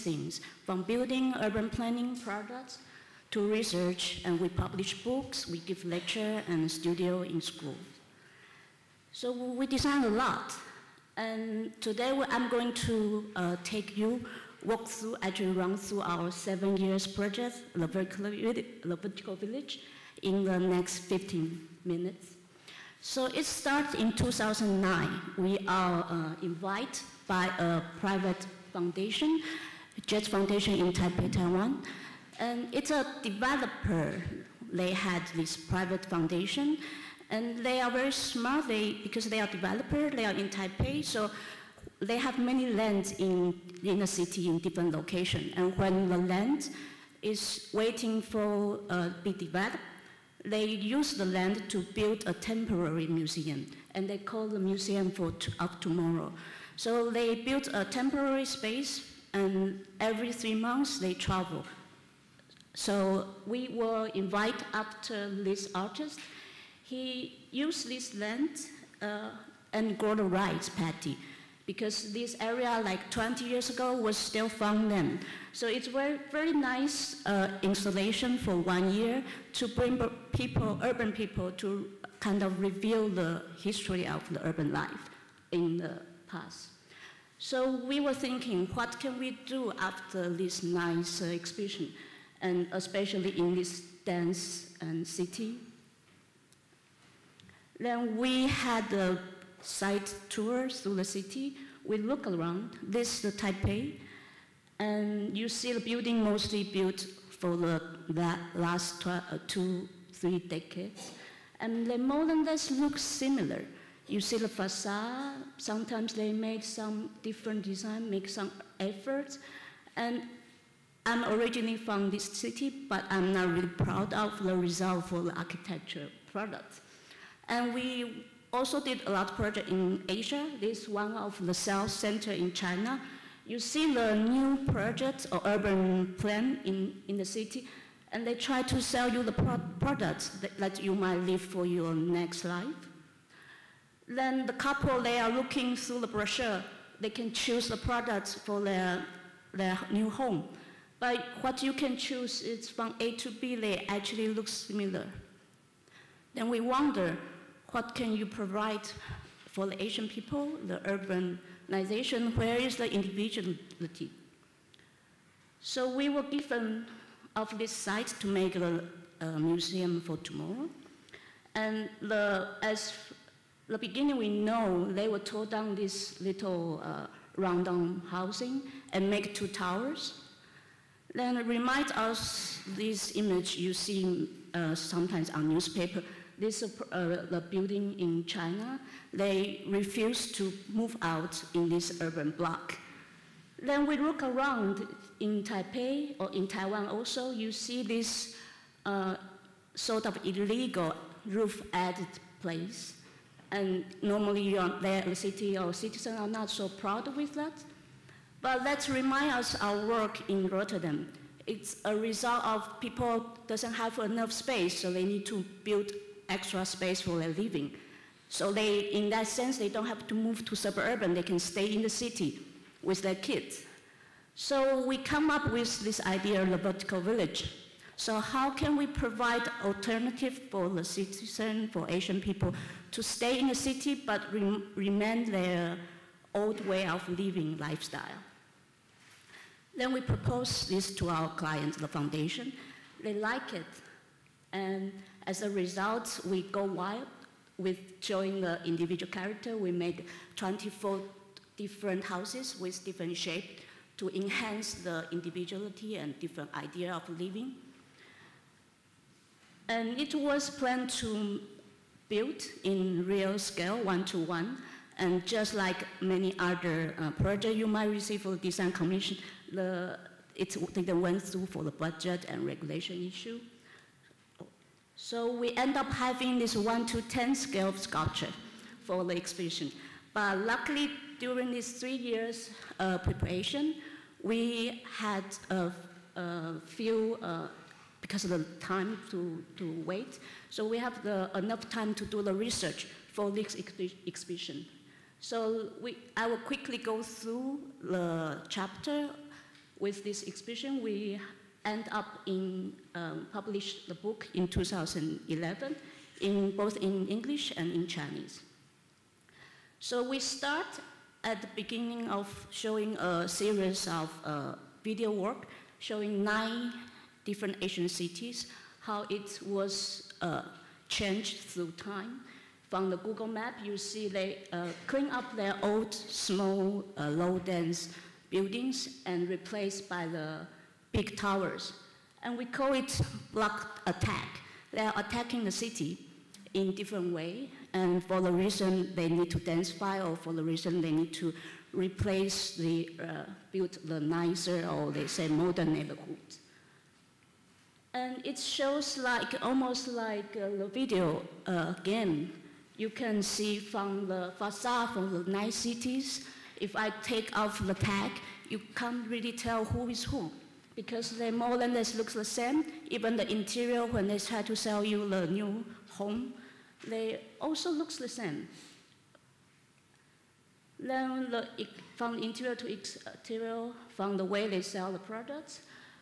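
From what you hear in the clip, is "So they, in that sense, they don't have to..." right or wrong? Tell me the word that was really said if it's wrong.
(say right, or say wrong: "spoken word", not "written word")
right.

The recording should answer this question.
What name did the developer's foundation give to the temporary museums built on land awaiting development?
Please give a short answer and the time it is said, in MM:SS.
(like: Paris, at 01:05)
museum for of tomorrow, at 00:54.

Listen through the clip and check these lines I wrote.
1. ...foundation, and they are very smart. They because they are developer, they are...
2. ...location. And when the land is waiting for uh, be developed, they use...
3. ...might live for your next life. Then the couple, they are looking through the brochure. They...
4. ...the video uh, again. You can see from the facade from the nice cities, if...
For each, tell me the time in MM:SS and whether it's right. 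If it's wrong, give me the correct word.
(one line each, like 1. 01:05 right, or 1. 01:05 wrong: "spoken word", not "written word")
1. 00:36 right
2. 00:44 right
3. 02:20 right
4. 05:50 right.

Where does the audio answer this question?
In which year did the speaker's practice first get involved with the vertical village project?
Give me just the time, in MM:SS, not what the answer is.
00:24.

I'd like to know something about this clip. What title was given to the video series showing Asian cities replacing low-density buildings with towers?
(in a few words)
block attack.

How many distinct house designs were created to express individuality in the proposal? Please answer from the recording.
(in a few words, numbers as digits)
24.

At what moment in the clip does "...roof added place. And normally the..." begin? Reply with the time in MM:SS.
03:21.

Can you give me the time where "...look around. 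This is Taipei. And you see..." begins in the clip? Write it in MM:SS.
01:41.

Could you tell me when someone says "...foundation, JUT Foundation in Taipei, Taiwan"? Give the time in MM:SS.
00:28.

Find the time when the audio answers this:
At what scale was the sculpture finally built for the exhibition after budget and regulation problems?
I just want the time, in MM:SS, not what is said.
04:36.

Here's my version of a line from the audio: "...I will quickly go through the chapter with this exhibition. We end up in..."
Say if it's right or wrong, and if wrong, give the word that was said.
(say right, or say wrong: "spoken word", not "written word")
right.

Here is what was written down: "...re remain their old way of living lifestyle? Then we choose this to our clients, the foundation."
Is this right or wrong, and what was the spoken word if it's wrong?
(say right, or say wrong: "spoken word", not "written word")
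wrong: "propose", not "choose".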